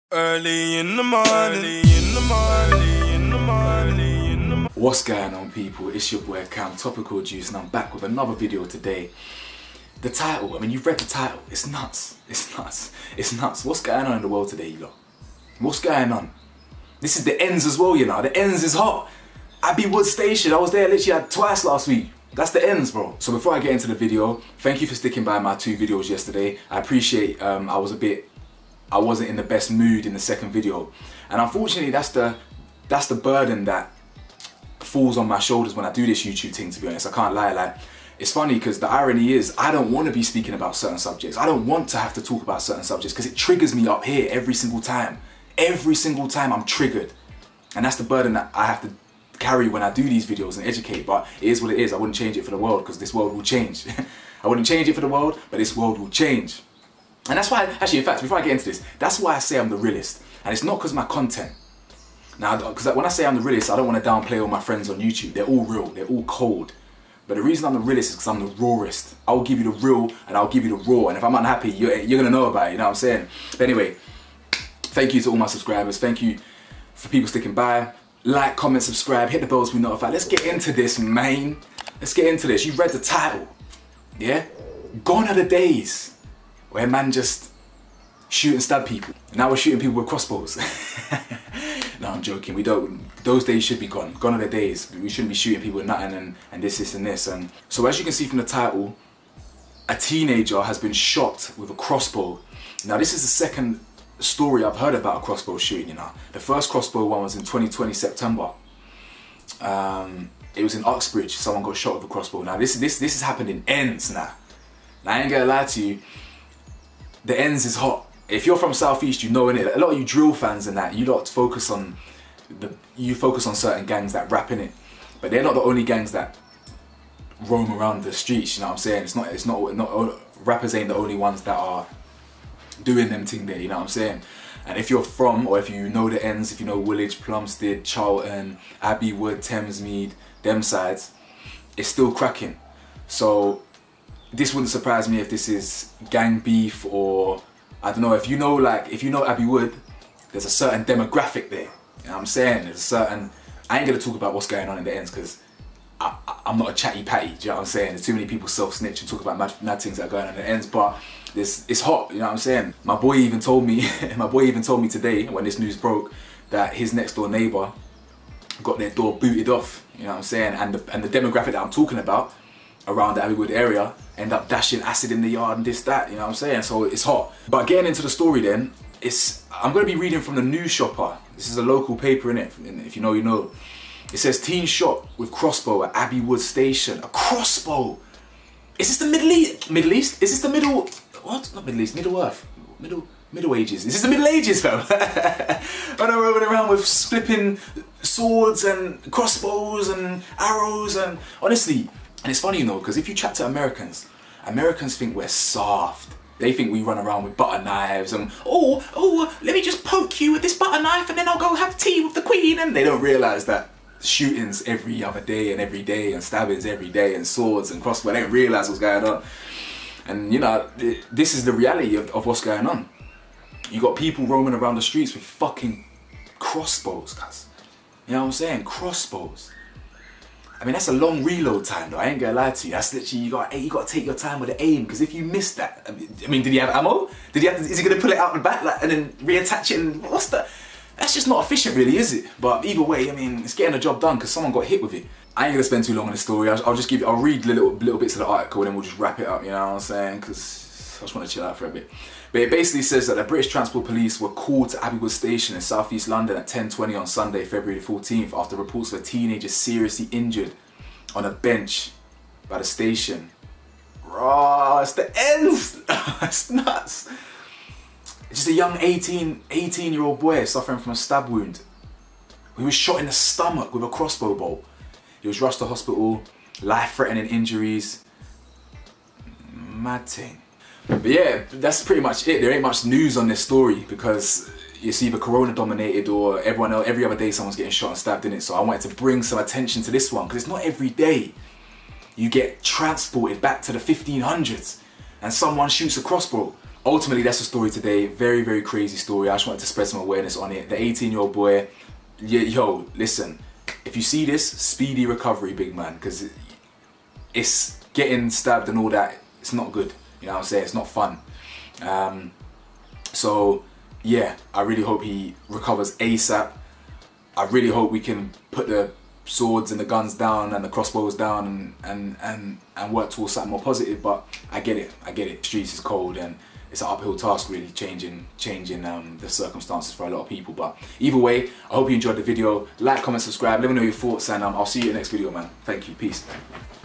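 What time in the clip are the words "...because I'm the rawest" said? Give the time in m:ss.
1:08.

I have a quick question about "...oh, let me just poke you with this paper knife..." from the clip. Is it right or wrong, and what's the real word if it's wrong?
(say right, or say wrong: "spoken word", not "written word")
wrong: "butter", not "paper".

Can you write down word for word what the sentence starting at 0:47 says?
And that's the burden that I have to carry when I do these videos and educate, but it is what it is.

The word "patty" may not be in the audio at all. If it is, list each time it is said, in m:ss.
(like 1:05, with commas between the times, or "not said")
2:37.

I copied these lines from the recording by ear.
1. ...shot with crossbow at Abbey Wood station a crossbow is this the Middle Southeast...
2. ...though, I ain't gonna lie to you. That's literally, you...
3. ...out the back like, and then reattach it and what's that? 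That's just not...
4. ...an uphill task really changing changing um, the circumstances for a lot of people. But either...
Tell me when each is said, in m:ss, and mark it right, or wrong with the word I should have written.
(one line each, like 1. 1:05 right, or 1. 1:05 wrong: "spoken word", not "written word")
1. 3:04 wrong: "East", not "Southeast"
2. 3:51 right
3. 3:58 right
4. 5:26 right.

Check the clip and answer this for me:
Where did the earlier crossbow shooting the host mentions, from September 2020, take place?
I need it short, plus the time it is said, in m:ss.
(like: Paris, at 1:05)
Uxbridge, at 1:50.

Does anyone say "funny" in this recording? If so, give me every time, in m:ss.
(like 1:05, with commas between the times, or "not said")
0:38, 3:22.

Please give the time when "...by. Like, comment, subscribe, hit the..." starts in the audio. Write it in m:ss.
1:17.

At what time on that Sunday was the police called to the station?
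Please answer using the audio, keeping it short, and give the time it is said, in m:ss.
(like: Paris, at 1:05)
10:20, at 4:16.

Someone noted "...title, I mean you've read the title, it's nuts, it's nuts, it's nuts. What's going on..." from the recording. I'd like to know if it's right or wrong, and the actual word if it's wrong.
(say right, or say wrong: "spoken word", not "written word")
right.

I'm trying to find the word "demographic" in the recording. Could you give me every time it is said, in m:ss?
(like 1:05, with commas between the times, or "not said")
2:30, 2:51.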